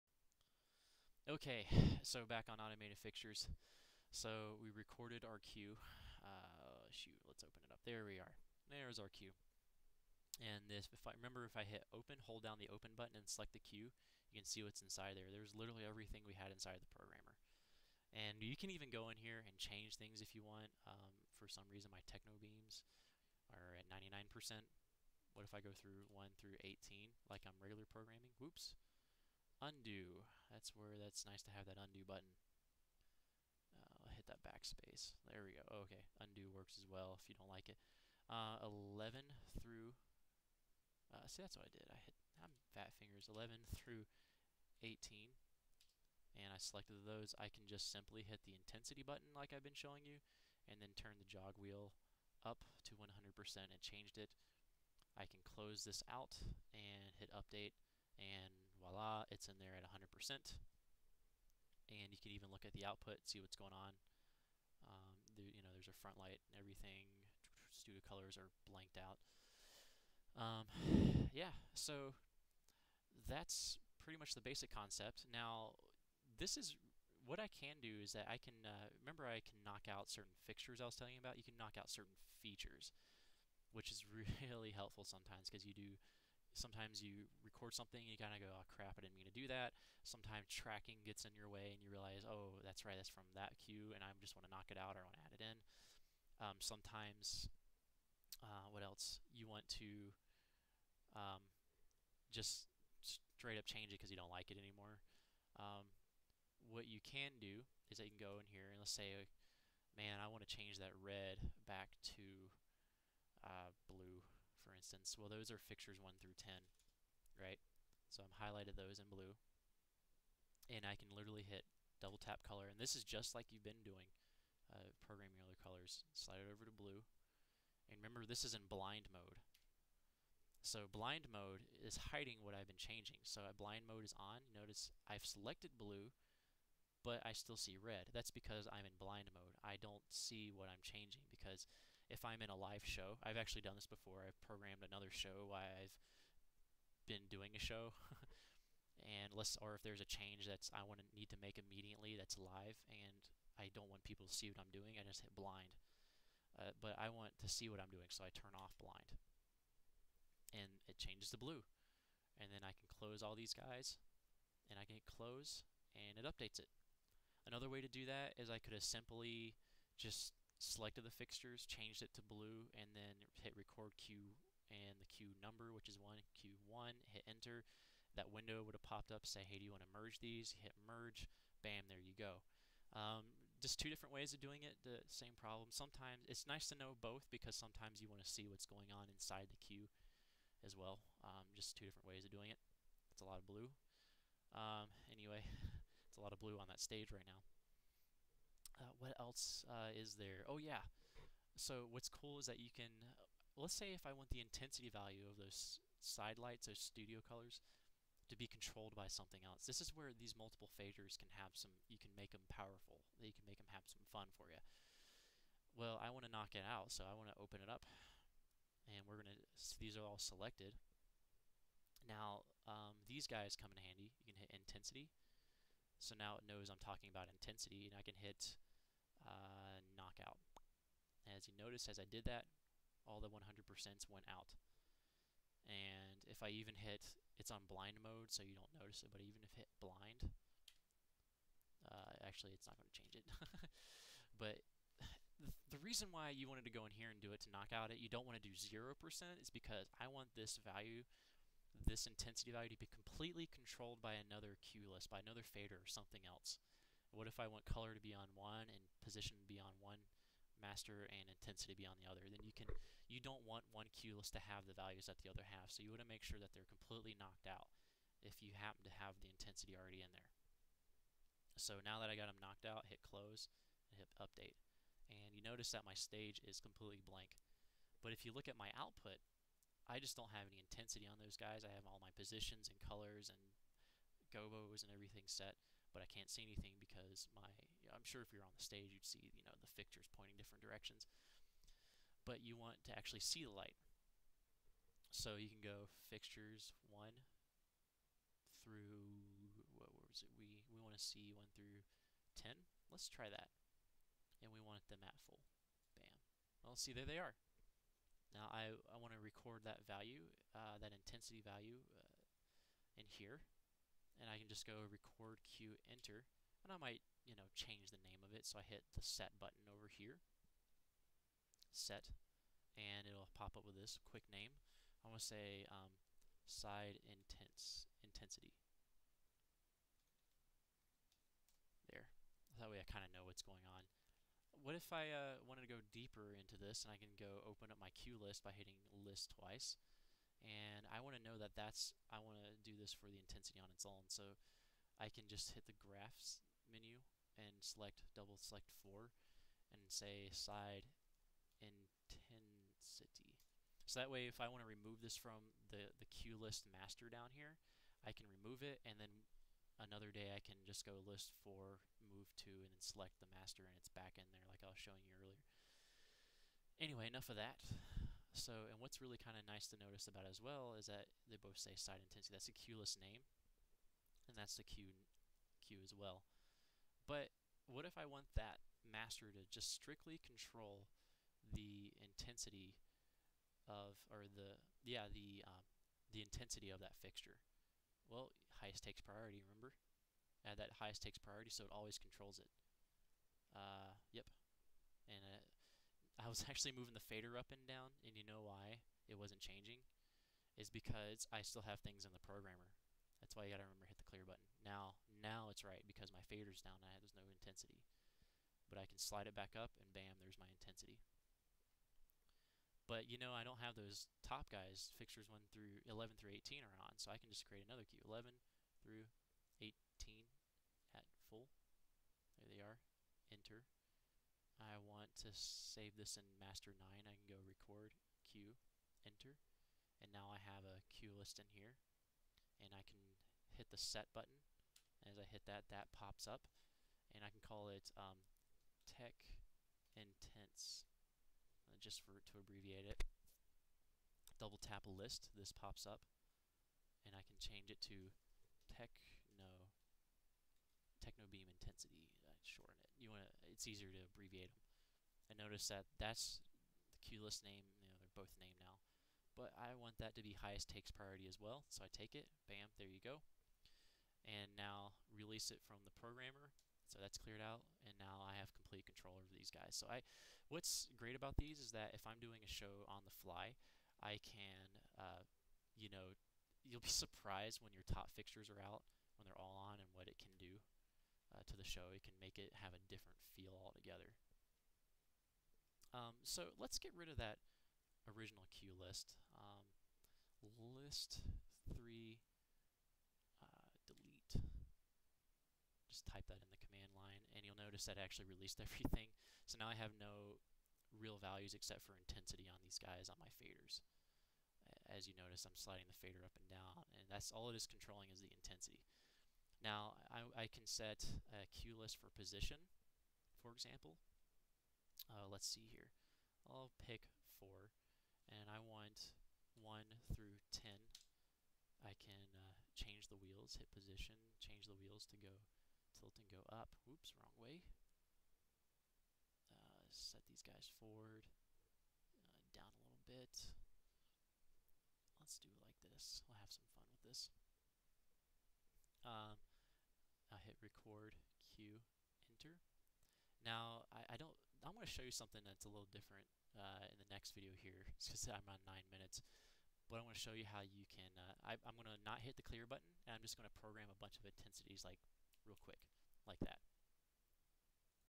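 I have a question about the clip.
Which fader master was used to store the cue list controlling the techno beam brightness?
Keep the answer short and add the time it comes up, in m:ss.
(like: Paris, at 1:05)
Master 9, at 7:06.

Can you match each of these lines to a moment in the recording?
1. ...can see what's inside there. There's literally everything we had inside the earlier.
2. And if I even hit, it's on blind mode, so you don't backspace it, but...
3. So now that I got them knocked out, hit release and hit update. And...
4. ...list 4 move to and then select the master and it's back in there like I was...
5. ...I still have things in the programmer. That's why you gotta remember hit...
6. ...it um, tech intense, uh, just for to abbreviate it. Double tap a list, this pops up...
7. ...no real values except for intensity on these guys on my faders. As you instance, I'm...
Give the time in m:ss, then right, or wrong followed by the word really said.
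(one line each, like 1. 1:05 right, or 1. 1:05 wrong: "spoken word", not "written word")
1. 0:14 wrong: "programmer", not "earlier"
2. 3:55 wrong: "notice", not "backspace"
3. 4:31 wrong: "close", not "release"
4. 6:01 right
5. 6:41 right
6. 7:17 right
7. 8:19 wrong: "notice", not "instance".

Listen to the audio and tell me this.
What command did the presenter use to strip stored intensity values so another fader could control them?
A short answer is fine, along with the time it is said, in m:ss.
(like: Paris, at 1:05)
Knockout, at 3:49.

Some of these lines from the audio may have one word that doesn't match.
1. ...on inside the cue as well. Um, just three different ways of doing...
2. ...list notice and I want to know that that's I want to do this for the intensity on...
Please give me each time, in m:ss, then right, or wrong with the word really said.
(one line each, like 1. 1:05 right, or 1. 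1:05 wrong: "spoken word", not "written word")
1. 3:08 wrong: "two", not "three"
2. 5:38 wrong: "twice", not "notice".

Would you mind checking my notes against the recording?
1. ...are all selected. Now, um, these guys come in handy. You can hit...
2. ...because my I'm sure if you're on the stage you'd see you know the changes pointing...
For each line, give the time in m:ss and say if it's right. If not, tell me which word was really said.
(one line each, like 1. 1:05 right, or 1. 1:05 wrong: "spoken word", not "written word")
1. 3:39 right
2. 4:46 wrong: "fixtures", not "changes".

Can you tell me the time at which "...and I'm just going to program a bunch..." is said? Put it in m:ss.
9:13.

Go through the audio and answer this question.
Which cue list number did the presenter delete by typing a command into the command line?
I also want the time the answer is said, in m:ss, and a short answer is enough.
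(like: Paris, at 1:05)
List 3, at 8:10.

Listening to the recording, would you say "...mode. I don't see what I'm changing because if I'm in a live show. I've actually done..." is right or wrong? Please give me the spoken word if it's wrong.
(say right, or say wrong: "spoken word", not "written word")
right.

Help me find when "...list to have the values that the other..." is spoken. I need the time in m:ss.
4:24.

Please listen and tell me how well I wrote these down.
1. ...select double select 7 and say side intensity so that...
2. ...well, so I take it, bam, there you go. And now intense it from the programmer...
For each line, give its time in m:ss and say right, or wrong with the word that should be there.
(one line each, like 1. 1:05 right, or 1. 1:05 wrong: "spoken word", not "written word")
1. 5:47 wrong: "4", not "7"
2. 7:41 wrong: "release", not "intense".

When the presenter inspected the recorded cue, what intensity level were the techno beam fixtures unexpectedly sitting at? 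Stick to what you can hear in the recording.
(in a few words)
99%.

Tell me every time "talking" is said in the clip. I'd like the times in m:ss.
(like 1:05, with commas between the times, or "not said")
3:46.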